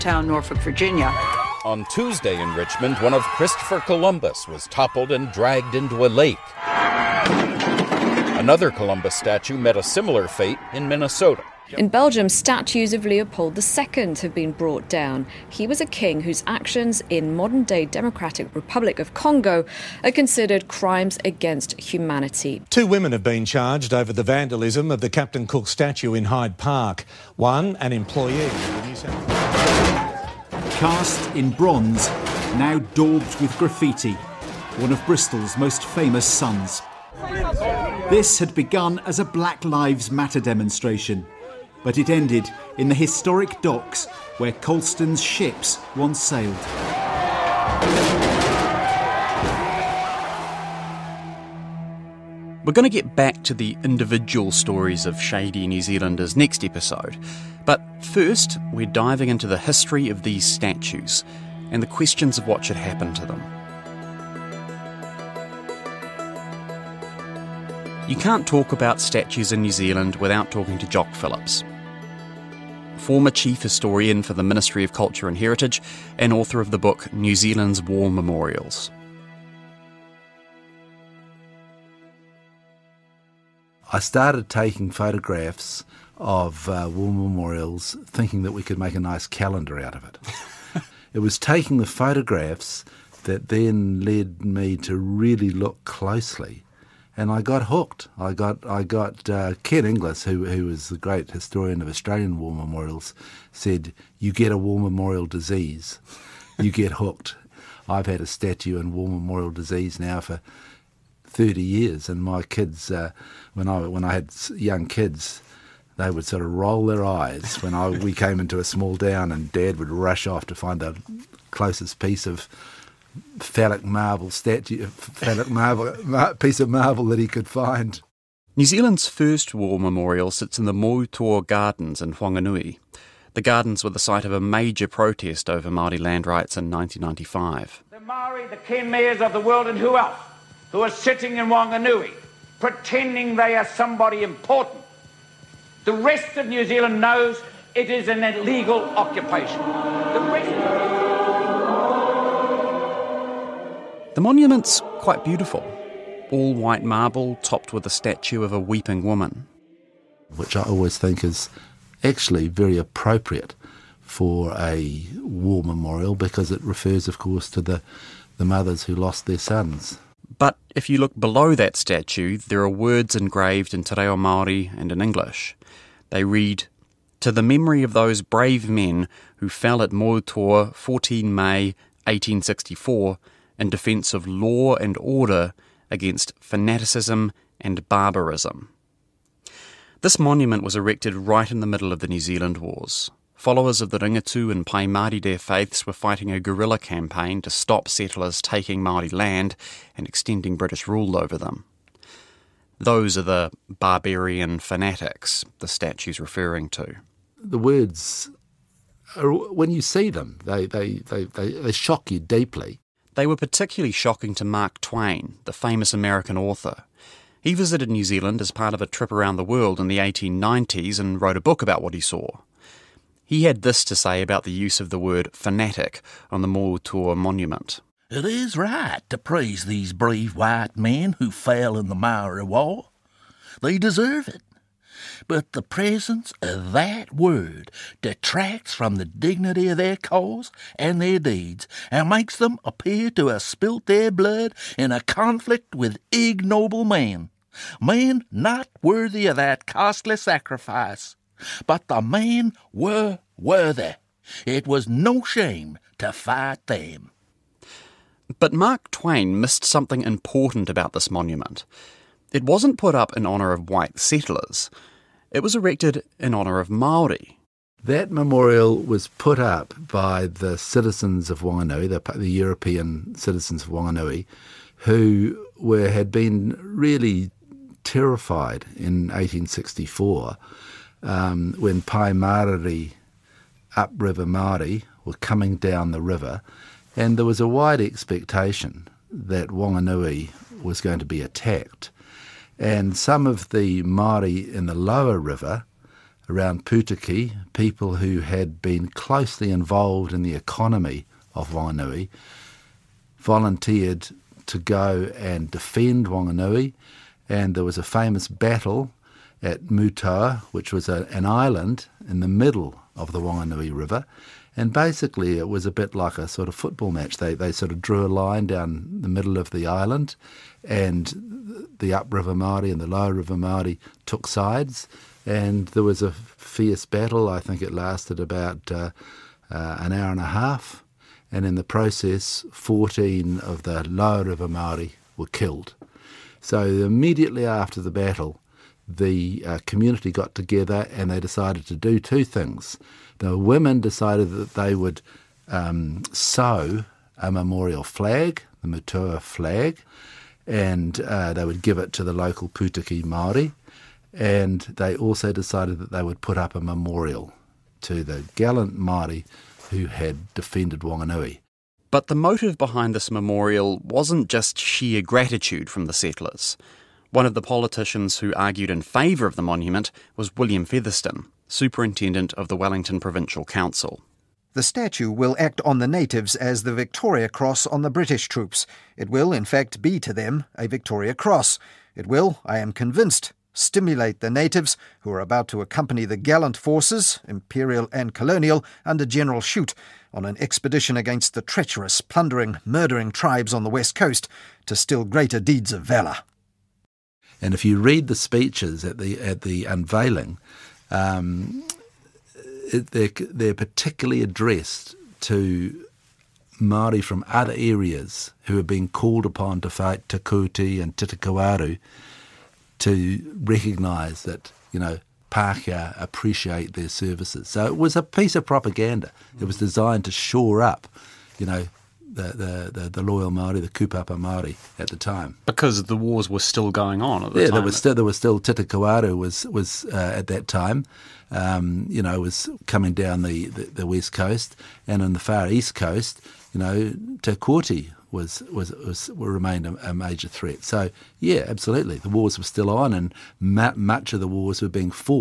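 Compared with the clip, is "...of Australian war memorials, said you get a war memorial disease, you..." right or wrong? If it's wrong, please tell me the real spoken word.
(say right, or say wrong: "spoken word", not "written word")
right.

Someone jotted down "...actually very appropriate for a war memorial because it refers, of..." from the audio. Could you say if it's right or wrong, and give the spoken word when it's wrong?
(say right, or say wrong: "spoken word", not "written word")
right.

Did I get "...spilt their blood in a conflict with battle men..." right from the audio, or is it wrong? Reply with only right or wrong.
wrong.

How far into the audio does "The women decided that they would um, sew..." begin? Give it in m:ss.
5:43.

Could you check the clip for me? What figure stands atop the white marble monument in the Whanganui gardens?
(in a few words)
A weeping woman.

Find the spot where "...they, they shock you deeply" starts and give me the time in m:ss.
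3:31.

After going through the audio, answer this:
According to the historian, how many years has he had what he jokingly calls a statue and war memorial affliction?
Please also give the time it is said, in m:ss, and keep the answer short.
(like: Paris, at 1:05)
30 years, at 1:51.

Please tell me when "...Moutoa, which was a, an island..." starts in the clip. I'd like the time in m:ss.
5:09.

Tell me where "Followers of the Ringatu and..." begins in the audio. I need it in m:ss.
3:13.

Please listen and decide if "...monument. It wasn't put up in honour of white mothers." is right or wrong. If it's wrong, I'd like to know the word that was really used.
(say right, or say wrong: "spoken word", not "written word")
wrong: "settlers", not "mothers".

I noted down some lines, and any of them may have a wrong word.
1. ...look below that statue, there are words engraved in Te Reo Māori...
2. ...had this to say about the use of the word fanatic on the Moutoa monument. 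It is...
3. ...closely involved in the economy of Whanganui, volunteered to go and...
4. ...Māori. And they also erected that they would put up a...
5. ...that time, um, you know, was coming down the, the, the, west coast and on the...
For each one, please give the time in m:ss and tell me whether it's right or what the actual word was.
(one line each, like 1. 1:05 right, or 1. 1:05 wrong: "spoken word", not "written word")
1. 2:50 right
2. 3:43 right
3. 4:58 right
4. 5:53 wrong: "decided", not "erected"
5. 7:10 right.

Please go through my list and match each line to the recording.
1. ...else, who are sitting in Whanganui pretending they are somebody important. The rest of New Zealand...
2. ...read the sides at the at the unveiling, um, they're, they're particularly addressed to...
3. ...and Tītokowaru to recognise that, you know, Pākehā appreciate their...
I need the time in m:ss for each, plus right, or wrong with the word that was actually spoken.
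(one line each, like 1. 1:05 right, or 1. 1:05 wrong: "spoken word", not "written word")
1. 2:19 right
2. 6:37 wrong: "speeches", not "sides"
3. 6:50 right.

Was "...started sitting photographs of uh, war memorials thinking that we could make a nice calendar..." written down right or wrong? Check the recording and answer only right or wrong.
wrong.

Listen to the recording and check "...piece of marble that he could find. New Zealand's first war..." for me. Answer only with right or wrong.
right.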